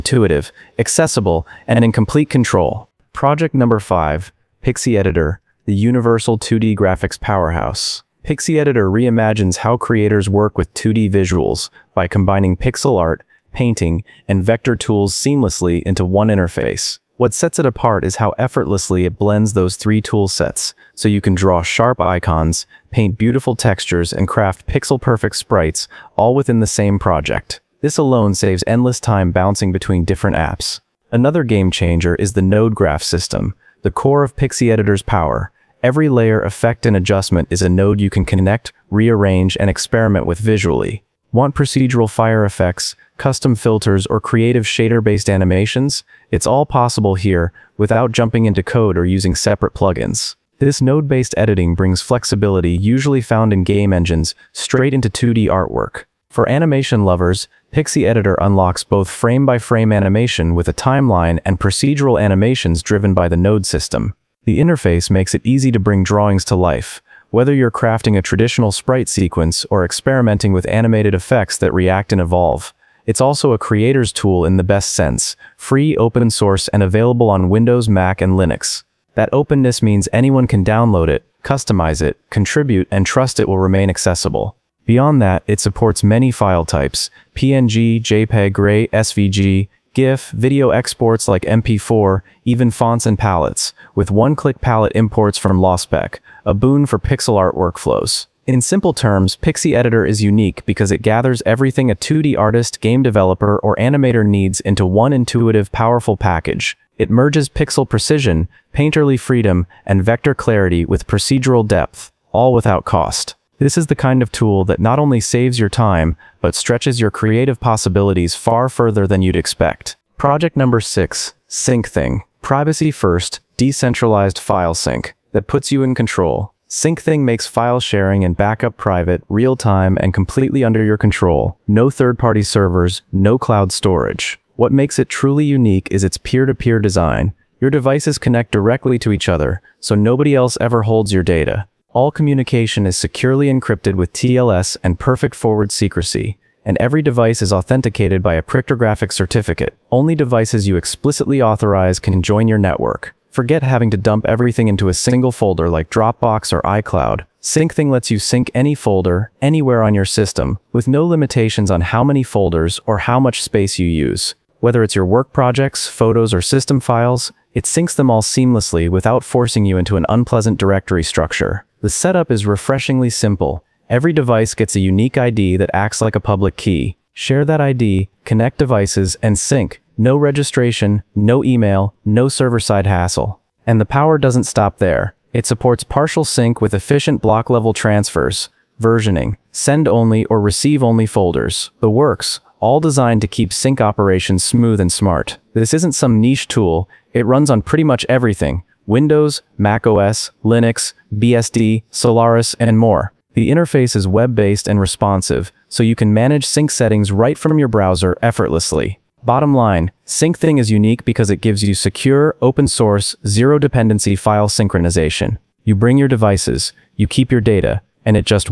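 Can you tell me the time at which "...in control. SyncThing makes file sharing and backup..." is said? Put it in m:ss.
2:05.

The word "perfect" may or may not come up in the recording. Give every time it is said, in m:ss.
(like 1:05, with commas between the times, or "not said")
0:24, 2:24.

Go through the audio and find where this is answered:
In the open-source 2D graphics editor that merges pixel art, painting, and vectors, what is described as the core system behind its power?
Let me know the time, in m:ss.
0:32.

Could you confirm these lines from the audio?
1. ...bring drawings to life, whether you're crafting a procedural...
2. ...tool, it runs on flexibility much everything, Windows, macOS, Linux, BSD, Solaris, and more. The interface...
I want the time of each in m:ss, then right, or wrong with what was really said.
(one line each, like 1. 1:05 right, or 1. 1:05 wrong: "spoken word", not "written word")
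1. 1:05 wrong: "traditional", not "procedural"
2. 3:16 wrong: "pretty", not "flexibility".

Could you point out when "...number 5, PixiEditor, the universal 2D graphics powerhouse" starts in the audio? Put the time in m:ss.
0:03.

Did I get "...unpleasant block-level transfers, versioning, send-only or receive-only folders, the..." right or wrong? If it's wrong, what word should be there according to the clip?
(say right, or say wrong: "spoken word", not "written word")
wrong: "efficient", not "unpleasant".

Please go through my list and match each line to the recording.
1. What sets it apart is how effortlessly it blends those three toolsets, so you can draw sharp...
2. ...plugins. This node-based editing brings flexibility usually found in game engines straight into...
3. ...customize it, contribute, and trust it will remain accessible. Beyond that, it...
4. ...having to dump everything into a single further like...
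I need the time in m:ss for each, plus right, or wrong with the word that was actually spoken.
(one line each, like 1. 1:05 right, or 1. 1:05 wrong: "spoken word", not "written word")
1. 0:17 right
2. 0:49 right
3. 1:21 right
4. 2:33 wrong: "folder", not "further".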